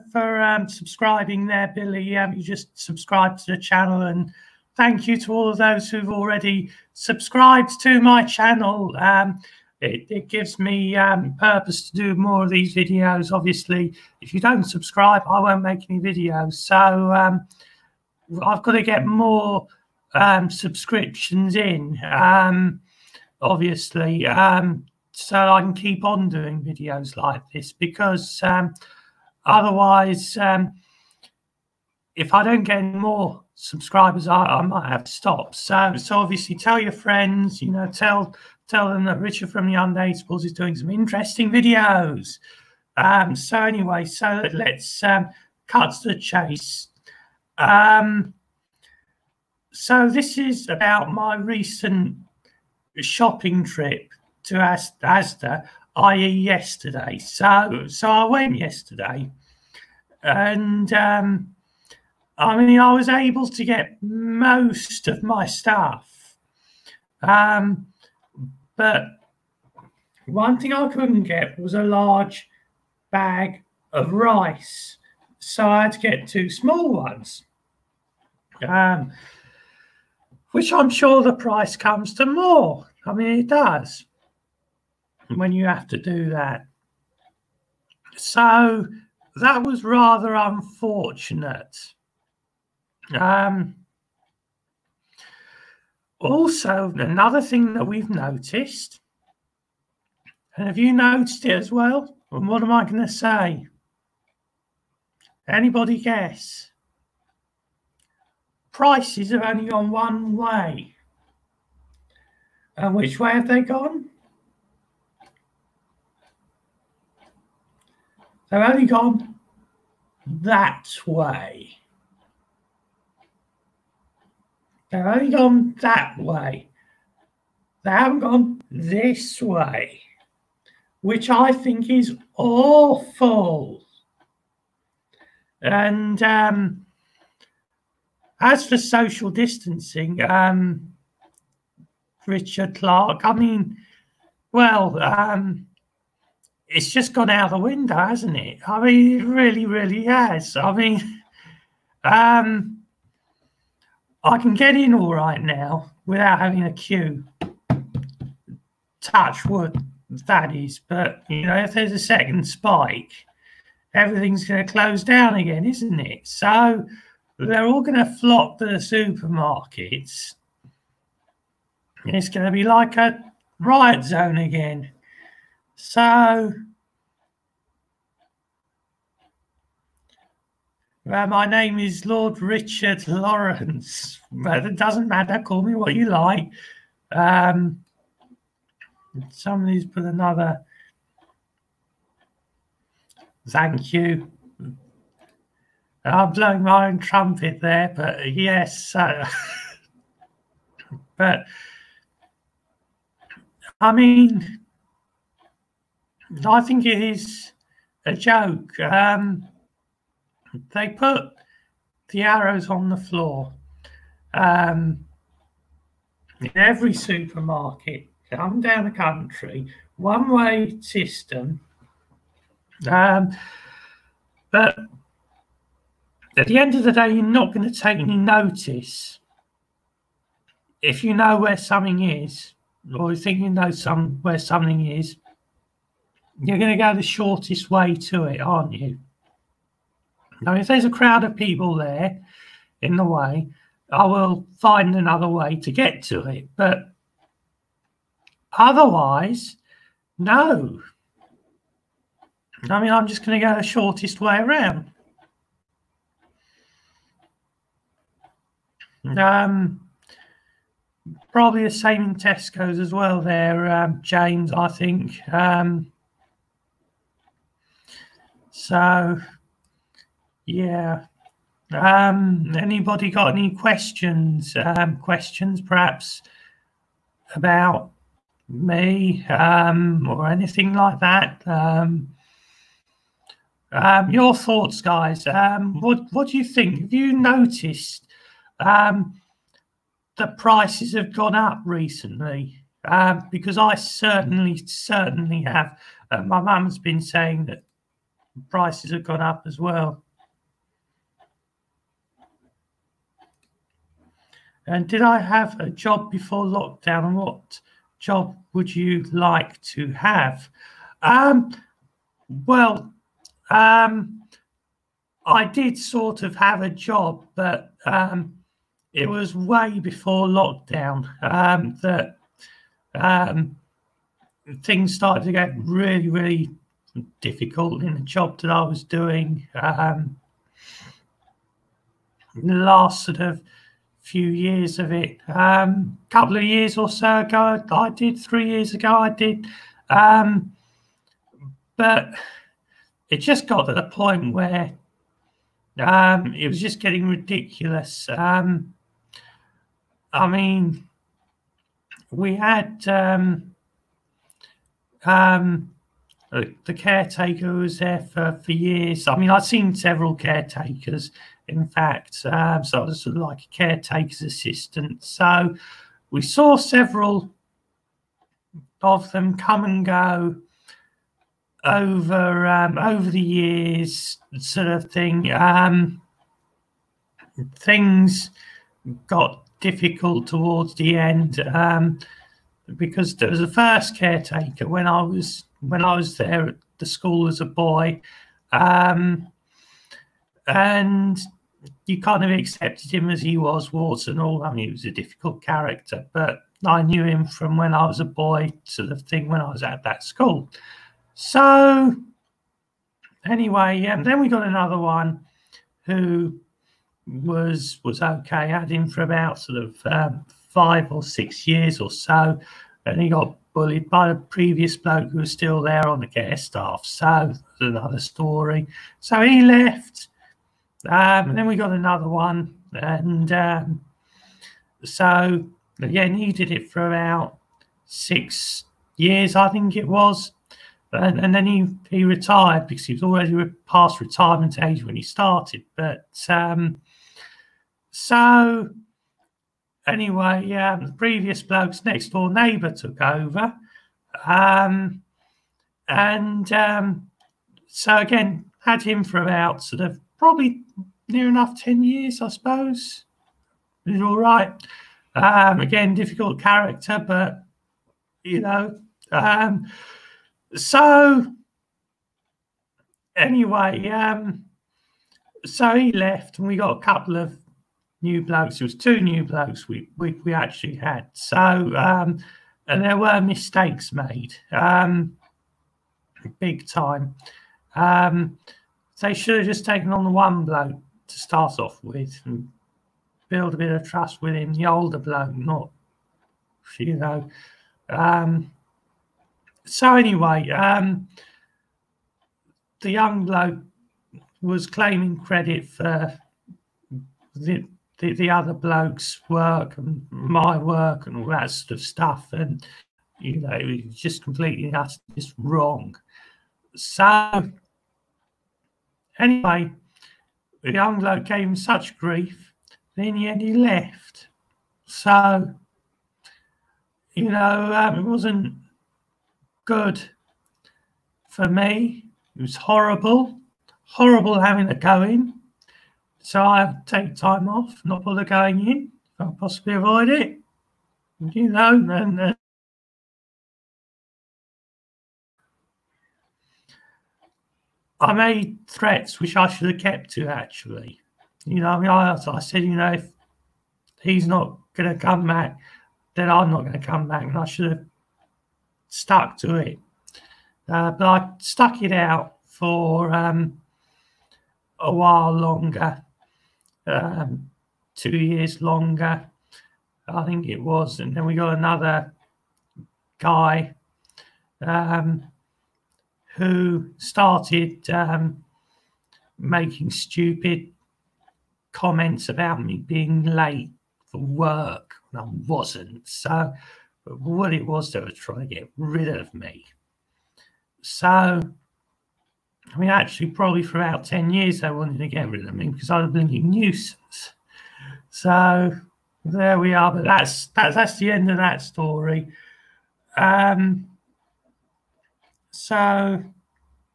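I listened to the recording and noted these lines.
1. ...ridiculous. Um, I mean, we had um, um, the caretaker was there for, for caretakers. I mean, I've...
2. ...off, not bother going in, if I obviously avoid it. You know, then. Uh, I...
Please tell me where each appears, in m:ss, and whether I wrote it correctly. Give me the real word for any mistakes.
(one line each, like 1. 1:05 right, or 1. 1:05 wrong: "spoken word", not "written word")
1. 5:47 wrong: "years", not "caretakers"
2. 8:47 wrong: "possibly", not "obviously".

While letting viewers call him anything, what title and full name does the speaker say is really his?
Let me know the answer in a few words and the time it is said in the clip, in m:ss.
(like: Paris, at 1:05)
Lord Richard Lawrence, at 3:02.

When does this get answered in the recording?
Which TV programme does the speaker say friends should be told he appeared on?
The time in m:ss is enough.
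0:39.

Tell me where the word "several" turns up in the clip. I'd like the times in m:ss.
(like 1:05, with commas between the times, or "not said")
5:59, 6:06.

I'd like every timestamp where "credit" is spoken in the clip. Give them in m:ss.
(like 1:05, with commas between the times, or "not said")
8:15.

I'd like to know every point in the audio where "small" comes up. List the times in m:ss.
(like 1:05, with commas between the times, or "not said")
1:16.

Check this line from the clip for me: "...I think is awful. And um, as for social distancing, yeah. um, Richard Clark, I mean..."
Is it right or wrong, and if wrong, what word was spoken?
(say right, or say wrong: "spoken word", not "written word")
right.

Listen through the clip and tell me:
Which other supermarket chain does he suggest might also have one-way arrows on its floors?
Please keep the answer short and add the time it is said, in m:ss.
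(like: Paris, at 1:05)
Tesco's, at 4:22.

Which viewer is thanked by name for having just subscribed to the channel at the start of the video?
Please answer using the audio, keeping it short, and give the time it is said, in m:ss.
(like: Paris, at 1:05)
Billy, at 0:01.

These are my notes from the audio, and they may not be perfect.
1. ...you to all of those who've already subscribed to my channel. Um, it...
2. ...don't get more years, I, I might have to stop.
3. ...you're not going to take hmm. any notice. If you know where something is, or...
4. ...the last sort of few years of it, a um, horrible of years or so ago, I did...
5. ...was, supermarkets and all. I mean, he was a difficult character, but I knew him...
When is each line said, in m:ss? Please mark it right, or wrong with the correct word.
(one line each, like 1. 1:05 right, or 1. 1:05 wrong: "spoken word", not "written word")
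1. 0:05 right
2. 0:32 wrong: "subscribers", not "years"
3. 3:47 right
4. 5:32 wrong: "couple", not "horrible"
5. 6:33 wrong: "warts", not "supermarkets".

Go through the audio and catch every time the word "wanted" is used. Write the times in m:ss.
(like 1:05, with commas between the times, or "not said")
9:44.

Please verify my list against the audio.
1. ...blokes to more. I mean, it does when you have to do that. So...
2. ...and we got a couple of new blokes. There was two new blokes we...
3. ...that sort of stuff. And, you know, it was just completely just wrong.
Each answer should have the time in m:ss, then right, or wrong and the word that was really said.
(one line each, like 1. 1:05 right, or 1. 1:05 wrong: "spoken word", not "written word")
1. 1:21 wrong: "comes", not "blokes"
2. 7:46 right
3. 8:21 right.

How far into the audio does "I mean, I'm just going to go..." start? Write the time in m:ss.
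4:12.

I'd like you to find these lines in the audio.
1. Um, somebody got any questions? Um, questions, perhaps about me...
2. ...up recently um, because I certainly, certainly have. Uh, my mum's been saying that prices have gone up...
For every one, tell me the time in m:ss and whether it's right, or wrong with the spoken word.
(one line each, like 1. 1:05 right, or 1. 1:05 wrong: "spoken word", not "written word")
1. 4:31 wrong: "anybody", not "somebody"
2. 4:51 right.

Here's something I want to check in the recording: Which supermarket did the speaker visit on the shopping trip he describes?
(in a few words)
Asda.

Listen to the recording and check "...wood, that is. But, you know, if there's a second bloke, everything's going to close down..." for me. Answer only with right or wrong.
wrong.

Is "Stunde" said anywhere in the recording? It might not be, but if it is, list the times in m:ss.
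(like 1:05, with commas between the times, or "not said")
not said.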